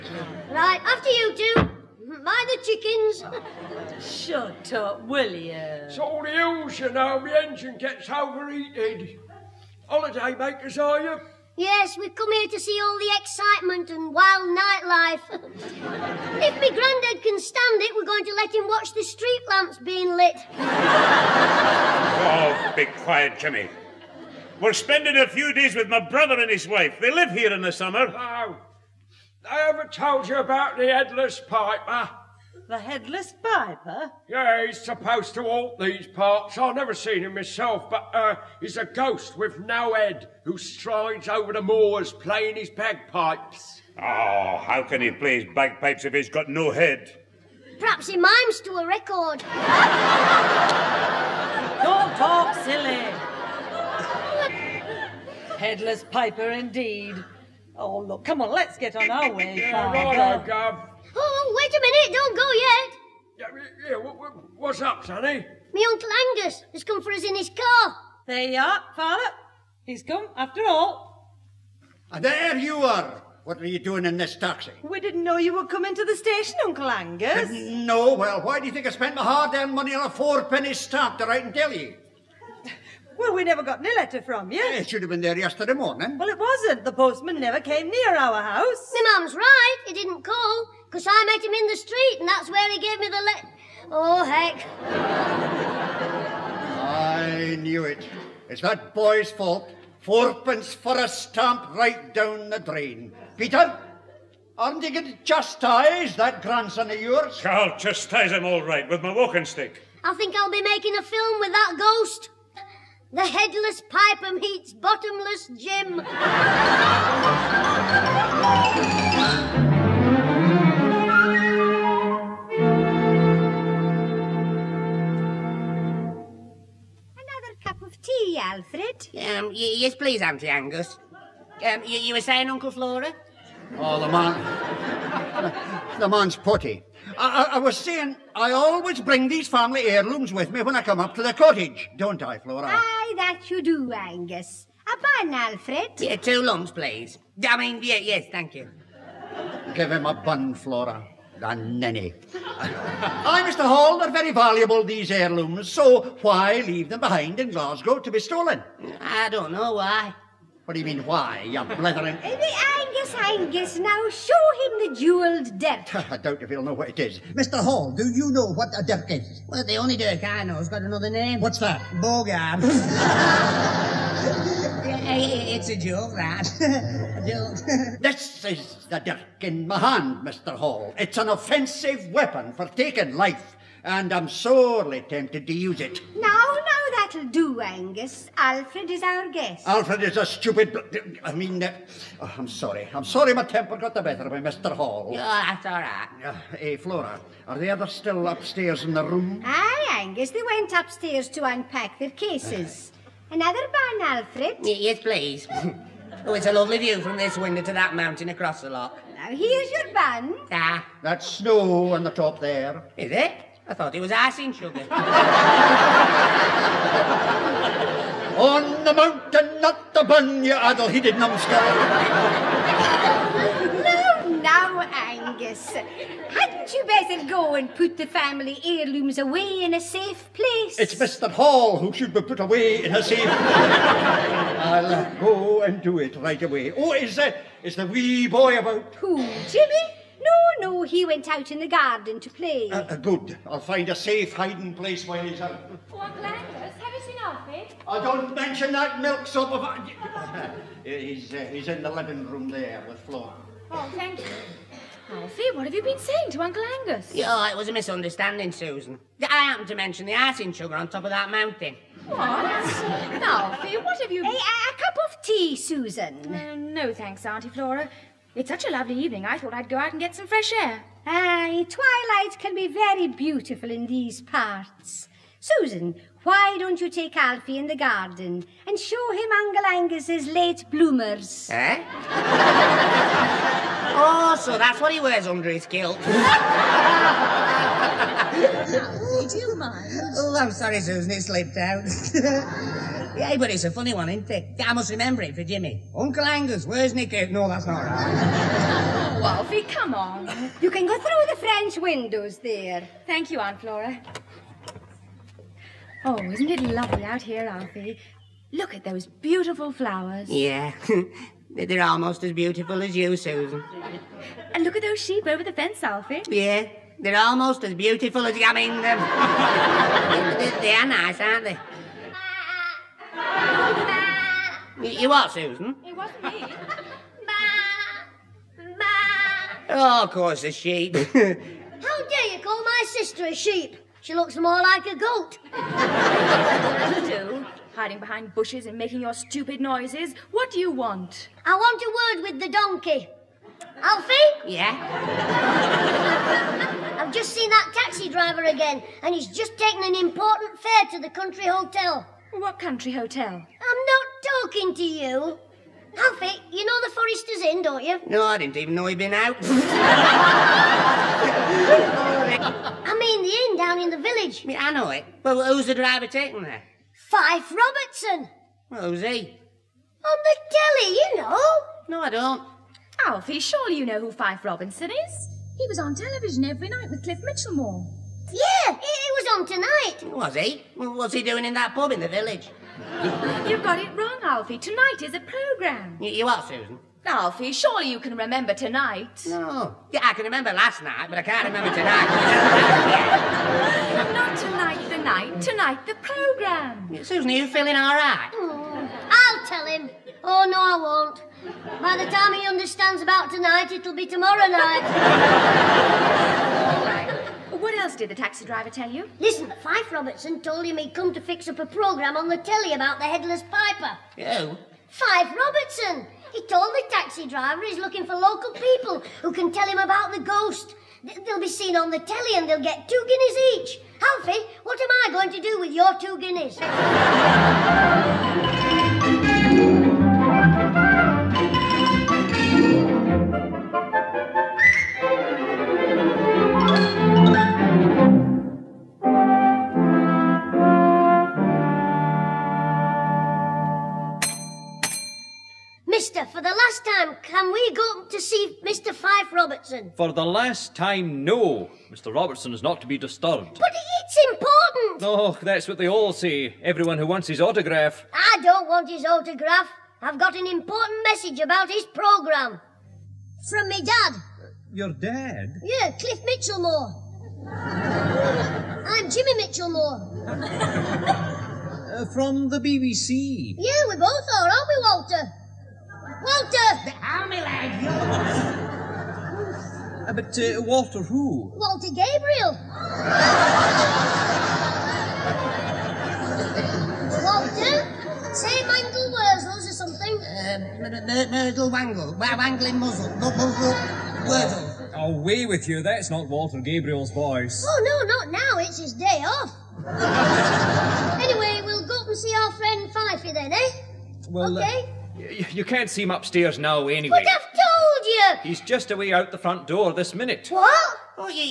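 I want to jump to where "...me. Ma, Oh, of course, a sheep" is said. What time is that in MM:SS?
05:26.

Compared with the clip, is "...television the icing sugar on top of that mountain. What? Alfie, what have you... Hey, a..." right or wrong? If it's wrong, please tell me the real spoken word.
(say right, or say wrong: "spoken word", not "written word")
wrong: "mention", not "television".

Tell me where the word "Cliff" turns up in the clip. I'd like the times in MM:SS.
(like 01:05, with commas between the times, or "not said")
06:17, 07:45.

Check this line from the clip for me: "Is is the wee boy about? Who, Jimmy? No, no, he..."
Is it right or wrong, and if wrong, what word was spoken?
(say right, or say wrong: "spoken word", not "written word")
right.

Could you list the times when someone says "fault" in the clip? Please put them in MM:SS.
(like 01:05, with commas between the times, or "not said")
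01:39.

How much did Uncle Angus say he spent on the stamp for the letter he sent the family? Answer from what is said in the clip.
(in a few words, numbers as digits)
4 pence.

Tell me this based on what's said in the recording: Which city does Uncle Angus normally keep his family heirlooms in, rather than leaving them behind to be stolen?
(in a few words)
Glasgow.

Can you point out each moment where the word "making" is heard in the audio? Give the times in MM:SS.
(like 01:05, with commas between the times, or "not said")
01:50, 05:38.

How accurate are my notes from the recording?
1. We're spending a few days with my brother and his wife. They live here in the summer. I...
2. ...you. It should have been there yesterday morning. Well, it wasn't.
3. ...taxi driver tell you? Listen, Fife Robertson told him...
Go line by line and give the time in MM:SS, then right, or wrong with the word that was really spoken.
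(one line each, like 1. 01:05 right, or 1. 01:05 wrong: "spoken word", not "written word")
1. 00:24 right
2. 01:24 right
3. 06:48 right.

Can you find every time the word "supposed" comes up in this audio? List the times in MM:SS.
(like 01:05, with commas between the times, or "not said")
00:34.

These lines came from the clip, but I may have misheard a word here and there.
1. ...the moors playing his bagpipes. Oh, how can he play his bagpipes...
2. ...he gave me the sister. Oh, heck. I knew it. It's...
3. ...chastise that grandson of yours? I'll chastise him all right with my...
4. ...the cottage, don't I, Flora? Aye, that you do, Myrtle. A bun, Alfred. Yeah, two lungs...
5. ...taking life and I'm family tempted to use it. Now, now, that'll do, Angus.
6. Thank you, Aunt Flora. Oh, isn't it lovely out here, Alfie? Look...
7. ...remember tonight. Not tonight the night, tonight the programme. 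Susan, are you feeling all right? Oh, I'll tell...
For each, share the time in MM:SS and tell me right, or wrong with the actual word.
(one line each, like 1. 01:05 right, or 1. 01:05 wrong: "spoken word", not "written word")
1. 00:41 right
2. 01:32 wrong: "letter", not "sister"
3. 01:45 right
4. 02:21 wrong: "Angus", not "Myrtle"
5. 03:02 wrong: "sorely", not "family"
6. 05:03 right
7. 06:31 right.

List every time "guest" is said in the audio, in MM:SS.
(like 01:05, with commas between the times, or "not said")
03:09.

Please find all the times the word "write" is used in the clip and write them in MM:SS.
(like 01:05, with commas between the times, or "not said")
01:21.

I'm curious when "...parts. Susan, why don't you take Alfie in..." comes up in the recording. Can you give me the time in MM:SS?
04:34.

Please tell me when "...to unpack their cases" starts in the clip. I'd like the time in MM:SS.
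03:21.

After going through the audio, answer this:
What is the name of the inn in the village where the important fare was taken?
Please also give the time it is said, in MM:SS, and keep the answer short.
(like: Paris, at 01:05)
The Forester's Inn, at 05:56.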